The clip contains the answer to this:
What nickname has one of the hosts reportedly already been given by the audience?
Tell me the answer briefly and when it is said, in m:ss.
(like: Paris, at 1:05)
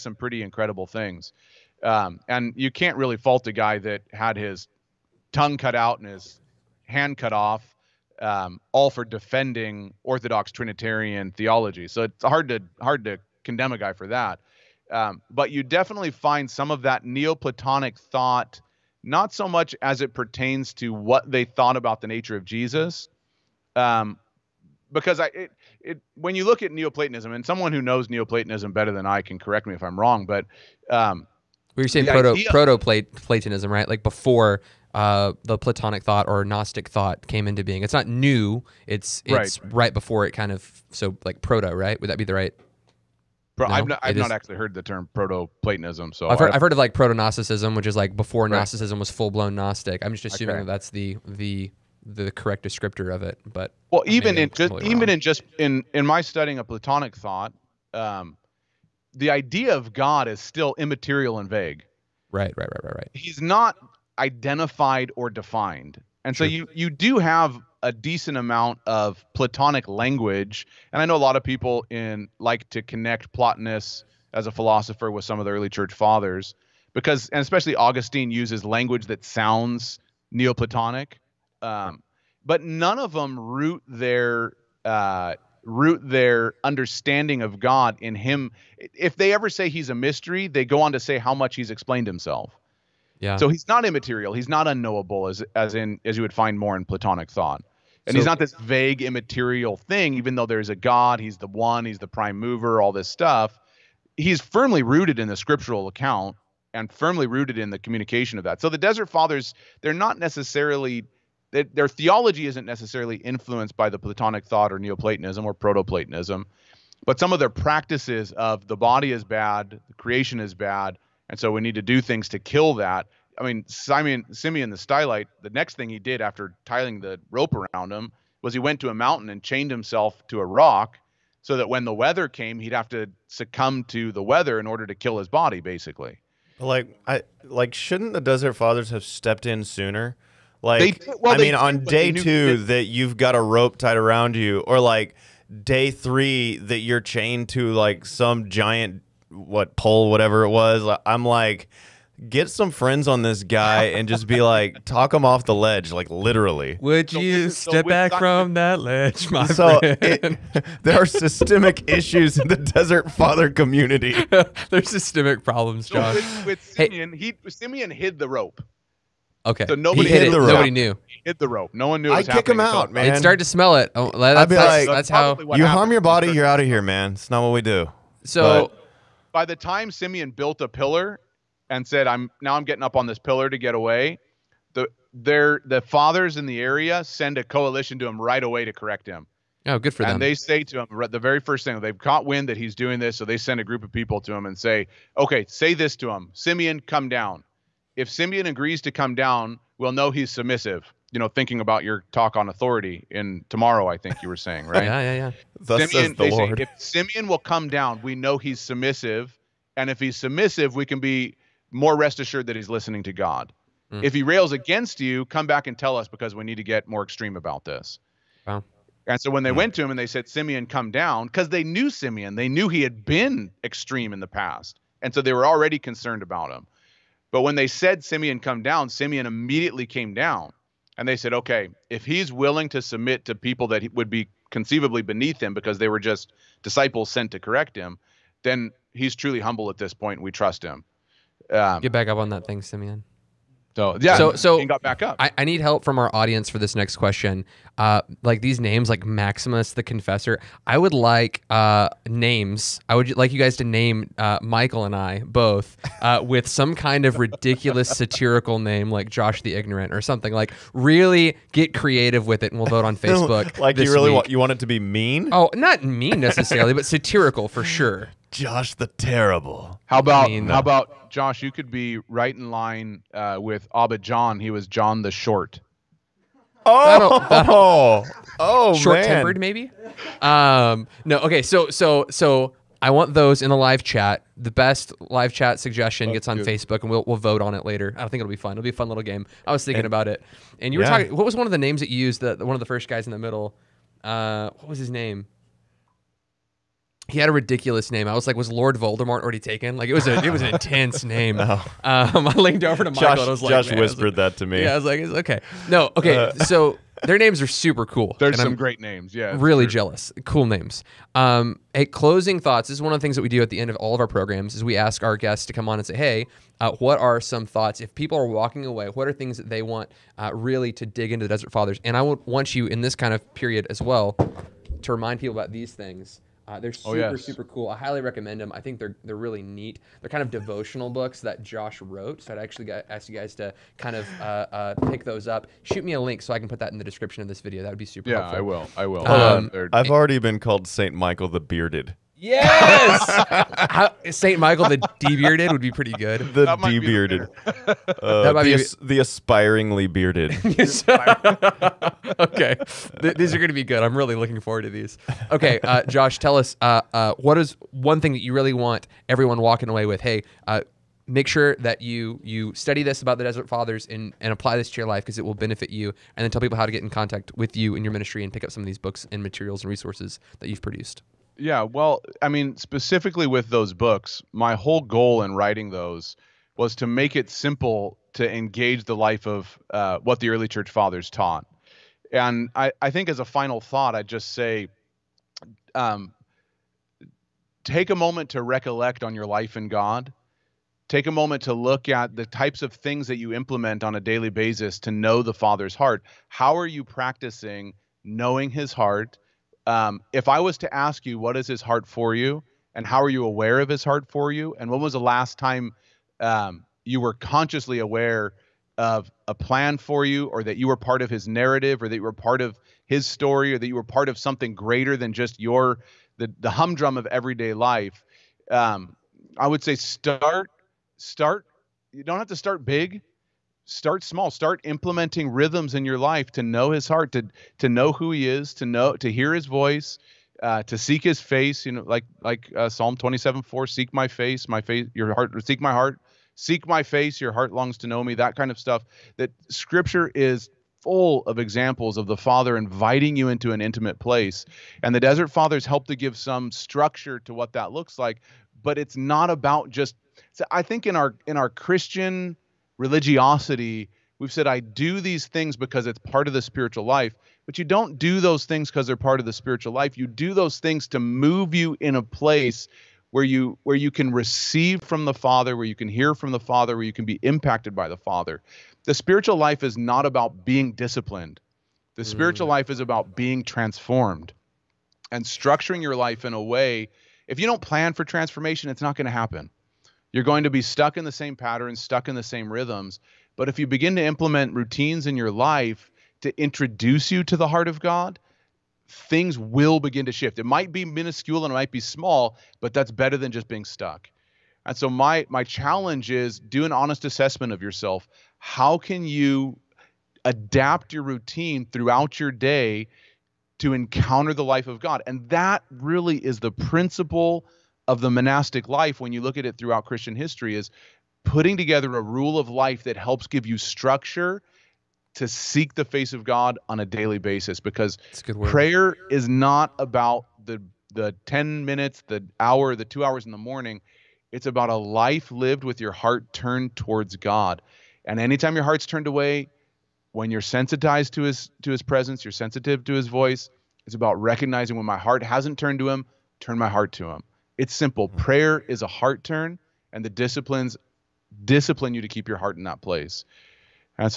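Saint Michael the Bearded, at 5:40.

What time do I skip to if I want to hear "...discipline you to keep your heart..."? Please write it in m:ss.
9:01.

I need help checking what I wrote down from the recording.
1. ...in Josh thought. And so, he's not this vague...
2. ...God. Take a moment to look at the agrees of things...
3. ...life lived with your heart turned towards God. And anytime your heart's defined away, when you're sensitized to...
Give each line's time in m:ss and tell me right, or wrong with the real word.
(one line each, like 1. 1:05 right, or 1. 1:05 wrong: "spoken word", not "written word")
1. 1:36 wrong: "Platonic", not "Josh"
2. 6:29 wrong: "types", not "agrees"
3. 8:44 wrong: "turned", not "defined".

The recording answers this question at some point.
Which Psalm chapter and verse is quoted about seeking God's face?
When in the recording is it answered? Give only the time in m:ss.
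7:12.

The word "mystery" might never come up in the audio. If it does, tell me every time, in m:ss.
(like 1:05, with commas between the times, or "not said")
1:29.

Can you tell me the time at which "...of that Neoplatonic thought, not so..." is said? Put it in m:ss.
0:16.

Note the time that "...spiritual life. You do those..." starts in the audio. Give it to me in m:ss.
7:39.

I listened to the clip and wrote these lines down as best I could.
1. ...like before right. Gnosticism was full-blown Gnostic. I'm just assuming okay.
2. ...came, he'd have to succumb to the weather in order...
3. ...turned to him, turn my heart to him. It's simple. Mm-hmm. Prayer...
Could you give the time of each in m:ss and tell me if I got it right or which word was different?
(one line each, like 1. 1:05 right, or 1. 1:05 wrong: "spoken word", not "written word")
1. 0:47 right
2. 2:12 right
3. 8:55 right.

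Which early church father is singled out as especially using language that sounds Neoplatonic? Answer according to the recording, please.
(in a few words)
Augustine.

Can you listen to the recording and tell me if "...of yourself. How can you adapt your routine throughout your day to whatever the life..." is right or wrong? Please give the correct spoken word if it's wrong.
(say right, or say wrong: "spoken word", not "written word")
wrong: "encounter", not "whatever".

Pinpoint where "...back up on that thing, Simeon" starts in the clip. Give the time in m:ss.
4:01.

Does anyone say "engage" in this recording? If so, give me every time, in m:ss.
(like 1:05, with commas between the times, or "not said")
6:18.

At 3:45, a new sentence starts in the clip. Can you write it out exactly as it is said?
And so they were already concerned about him.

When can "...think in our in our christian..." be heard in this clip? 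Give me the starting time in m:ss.
7:30.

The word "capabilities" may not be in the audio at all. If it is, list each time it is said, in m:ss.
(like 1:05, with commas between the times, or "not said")
not said.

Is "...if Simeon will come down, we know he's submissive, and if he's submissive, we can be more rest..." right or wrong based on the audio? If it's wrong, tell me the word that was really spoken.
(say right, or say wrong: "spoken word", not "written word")
right.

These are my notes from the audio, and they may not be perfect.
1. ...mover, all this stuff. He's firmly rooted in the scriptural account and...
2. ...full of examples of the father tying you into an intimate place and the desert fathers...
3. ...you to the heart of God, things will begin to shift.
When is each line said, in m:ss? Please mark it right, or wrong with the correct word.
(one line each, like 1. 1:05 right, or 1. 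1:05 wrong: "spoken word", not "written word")
1. 1:42 right
2. 7:20 wrong: "inviting", not "tying"
3. 8:07 right.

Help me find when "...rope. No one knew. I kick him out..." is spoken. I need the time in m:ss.
2:51.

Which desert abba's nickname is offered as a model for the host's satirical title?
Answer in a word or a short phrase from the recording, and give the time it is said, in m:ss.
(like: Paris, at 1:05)
John the Short, at 4:34.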